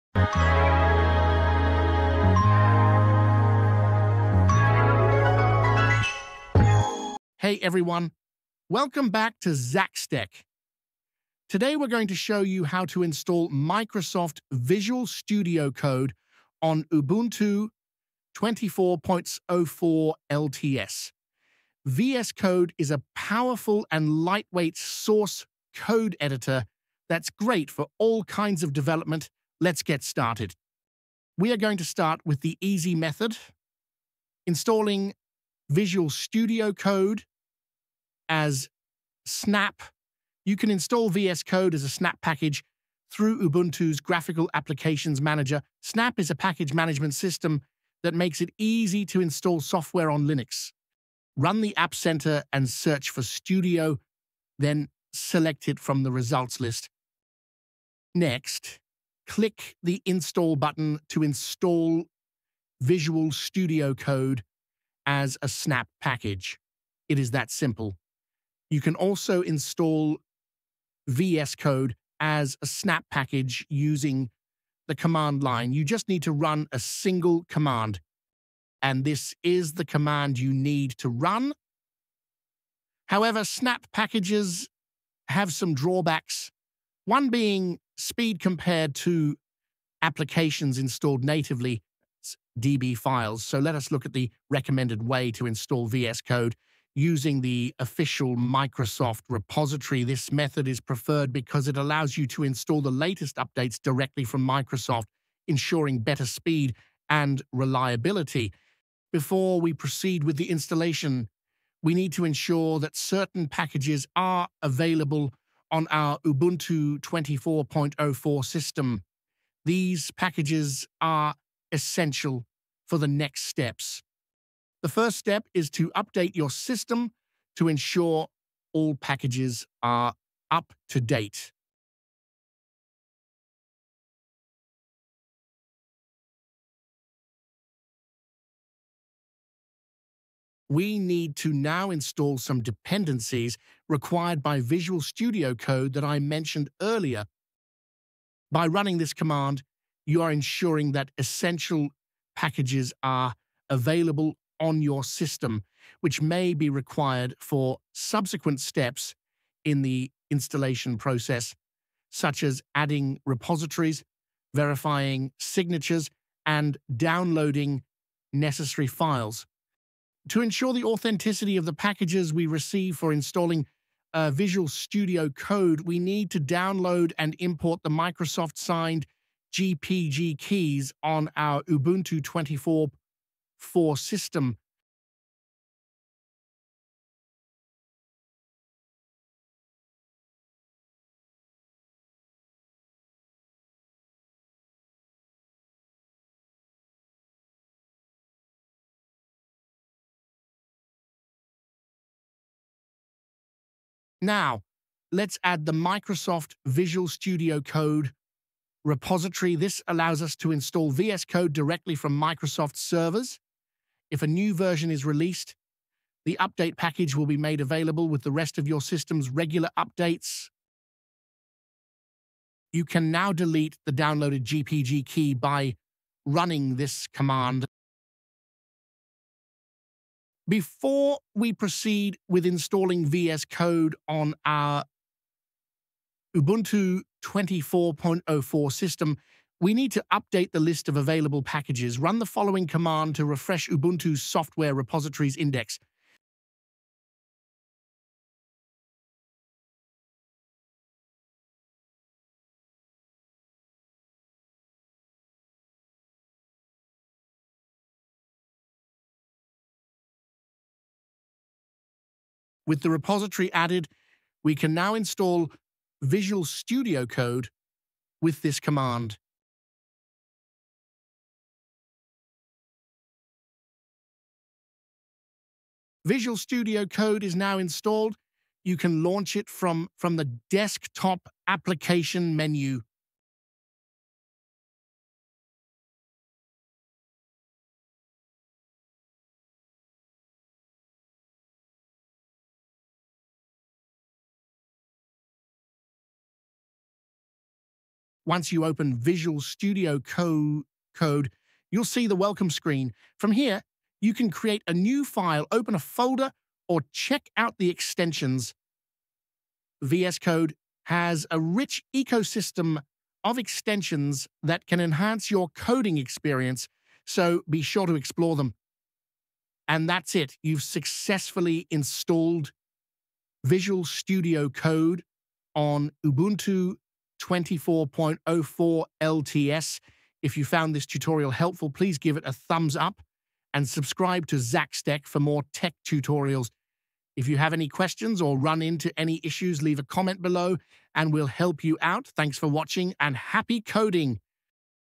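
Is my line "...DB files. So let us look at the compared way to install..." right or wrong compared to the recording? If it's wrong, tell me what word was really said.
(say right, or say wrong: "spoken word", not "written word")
wrong: "recommended", not "compared".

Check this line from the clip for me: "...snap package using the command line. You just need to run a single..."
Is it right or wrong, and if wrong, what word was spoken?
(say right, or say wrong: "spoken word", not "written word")
right.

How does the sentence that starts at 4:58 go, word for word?
Once you open Visual Studio Co Code, you'll see the welcome screen.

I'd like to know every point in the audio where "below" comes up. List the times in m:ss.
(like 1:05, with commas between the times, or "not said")
5:40.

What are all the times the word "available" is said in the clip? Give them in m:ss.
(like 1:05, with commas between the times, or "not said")
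1:54, 2:33, 3:37, 4:00.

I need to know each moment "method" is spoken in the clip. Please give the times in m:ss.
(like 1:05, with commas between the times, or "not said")
0:32, 1:40.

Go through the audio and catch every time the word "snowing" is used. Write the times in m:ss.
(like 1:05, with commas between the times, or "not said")
not said.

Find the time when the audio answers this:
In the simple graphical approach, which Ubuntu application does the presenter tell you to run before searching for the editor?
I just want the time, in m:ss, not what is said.
0:51.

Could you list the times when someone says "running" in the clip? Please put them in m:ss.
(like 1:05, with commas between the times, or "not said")
2:28, 3:46.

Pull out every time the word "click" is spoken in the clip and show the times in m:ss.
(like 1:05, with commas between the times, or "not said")
0:59.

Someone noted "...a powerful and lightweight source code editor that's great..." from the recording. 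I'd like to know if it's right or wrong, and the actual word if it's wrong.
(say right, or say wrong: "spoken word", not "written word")
right.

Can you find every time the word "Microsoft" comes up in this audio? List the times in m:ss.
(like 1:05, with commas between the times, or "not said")
0:13, 1:38, 1:44, 2:57, 3:25, 3:32.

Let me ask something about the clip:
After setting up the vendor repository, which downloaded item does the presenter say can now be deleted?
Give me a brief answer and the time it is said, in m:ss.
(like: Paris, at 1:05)
GPG key, at 3:44.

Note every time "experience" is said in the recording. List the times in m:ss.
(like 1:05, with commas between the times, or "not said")
5:15.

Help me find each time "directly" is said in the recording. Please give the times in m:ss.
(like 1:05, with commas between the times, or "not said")
1:43, 3:31.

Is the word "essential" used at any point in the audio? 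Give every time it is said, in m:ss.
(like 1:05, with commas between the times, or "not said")
2:01, 2:31.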